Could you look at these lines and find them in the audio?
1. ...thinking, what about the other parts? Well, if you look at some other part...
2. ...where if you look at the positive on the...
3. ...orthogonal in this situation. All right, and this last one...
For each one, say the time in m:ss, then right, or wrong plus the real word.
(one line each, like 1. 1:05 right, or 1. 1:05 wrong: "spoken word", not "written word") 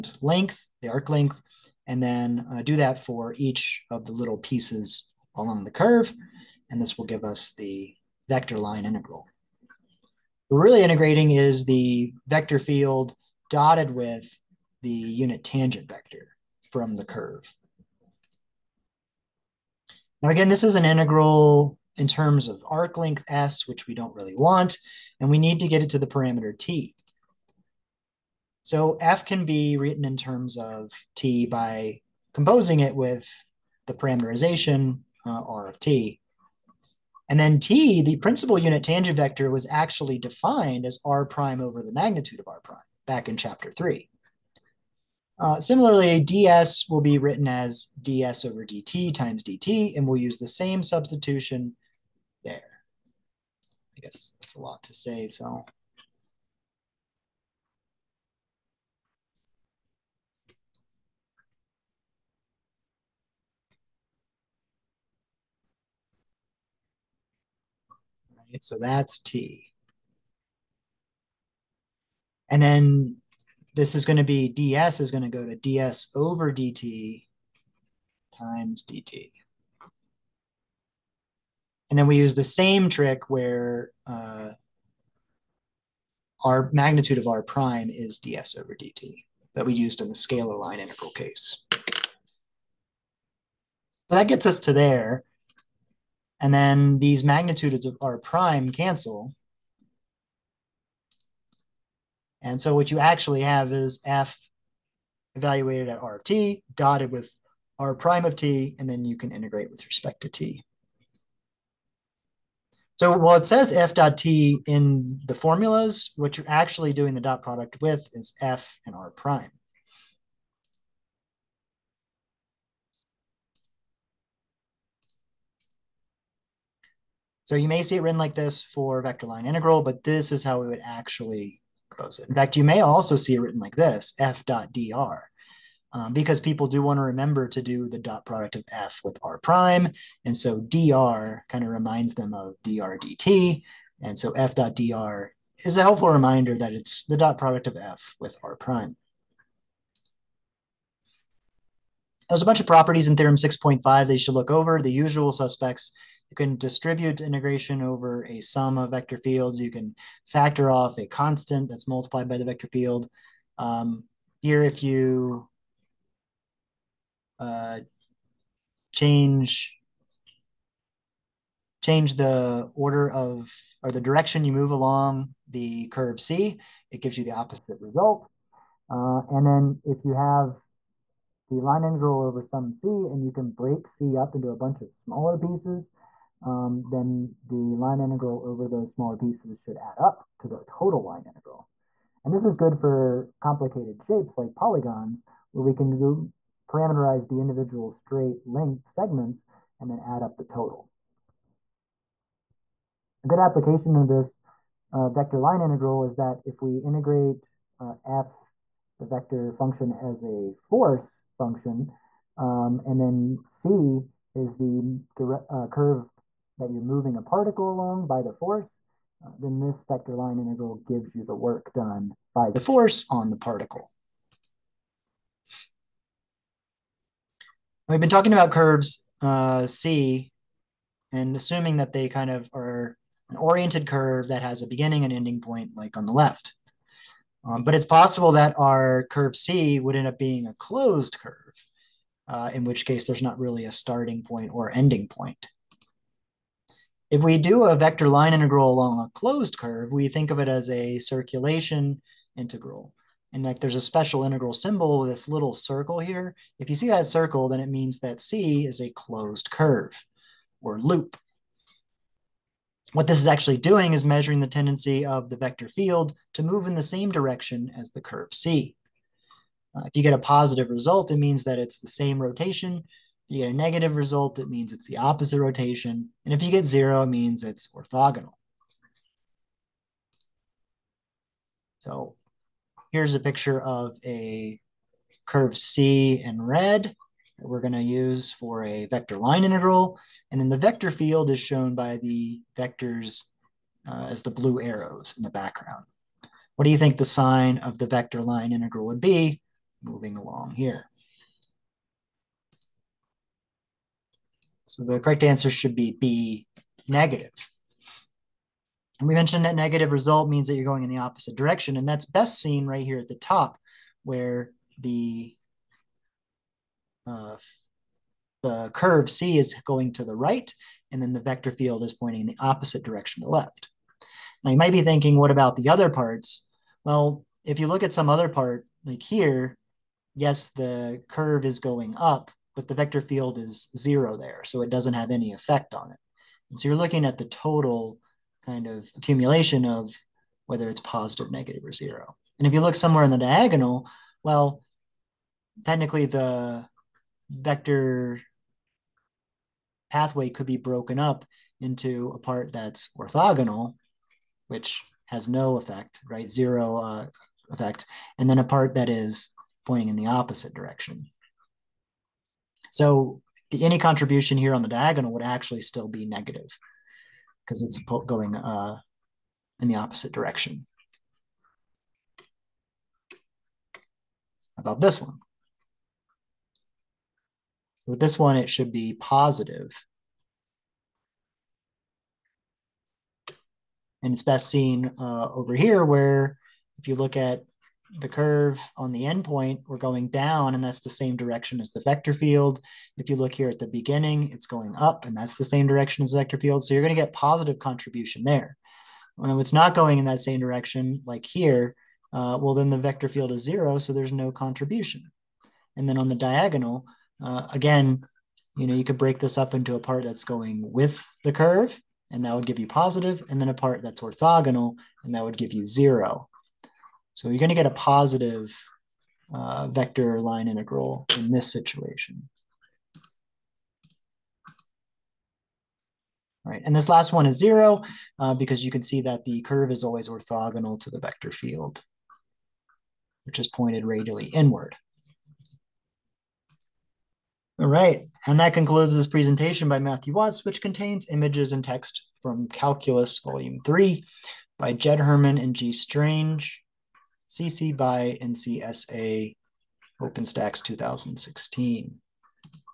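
1. 5:24 right
2. 6:25 wrong: "curve", not "positive"
3. 7:00 wrong: "integral", not "orthogonal".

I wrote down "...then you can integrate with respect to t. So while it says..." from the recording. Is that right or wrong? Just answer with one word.
right.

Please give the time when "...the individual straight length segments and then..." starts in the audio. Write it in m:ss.
3:17.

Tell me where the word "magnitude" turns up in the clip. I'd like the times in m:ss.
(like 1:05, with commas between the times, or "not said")
0:41, 1:26, 1:37.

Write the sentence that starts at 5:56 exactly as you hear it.
Zero uh, effect, and then a part that is pointing in the opposite direction.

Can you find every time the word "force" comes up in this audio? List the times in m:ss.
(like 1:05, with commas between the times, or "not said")
3:30, 3:38, 3:42.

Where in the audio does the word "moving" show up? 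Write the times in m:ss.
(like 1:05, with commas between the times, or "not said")
3:36, 4:59.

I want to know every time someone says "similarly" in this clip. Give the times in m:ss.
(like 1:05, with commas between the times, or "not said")
0:45.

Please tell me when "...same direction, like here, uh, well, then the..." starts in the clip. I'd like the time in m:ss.
6:40.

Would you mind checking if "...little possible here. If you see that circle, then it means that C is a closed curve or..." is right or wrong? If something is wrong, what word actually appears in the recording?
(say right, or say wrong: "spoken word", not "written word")
wrong: "circle", not "possible".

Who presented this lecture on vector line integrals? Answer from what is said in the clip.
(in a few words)
Matthew Watts.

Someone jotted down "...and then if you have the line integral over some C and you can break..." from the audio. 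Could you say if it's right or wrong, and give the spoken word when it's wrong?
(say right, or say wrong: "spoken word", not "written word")
right.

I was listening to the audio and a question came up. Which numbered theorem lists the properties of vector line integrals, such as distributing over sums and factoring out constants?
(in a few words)
Theorem 6.5.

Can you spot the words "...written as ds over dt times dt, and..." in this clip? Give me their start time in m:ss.
0:47.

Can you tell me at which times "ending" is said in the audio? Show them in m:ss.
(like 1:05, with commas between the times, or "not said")
3:55, 4:04.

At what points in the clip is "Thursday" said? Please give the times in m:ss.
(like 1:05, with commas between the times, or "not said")
not said.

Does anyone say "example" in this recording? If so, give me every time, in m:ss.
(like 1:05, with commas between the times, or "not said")
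not said.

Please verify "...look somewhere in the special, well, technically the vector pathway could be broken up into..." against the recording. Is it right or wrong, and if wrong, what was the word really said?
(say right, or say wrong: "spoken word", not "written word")
wrong: "diagonal", not "special".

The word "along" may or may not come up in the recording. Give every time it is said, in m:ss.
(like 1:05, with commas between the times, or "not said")
0:05, 2:54, 3:37, 4:08, 5:00.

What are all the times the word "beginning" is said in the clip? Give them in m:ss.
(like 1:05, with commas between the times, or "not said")
3:54, 6:33.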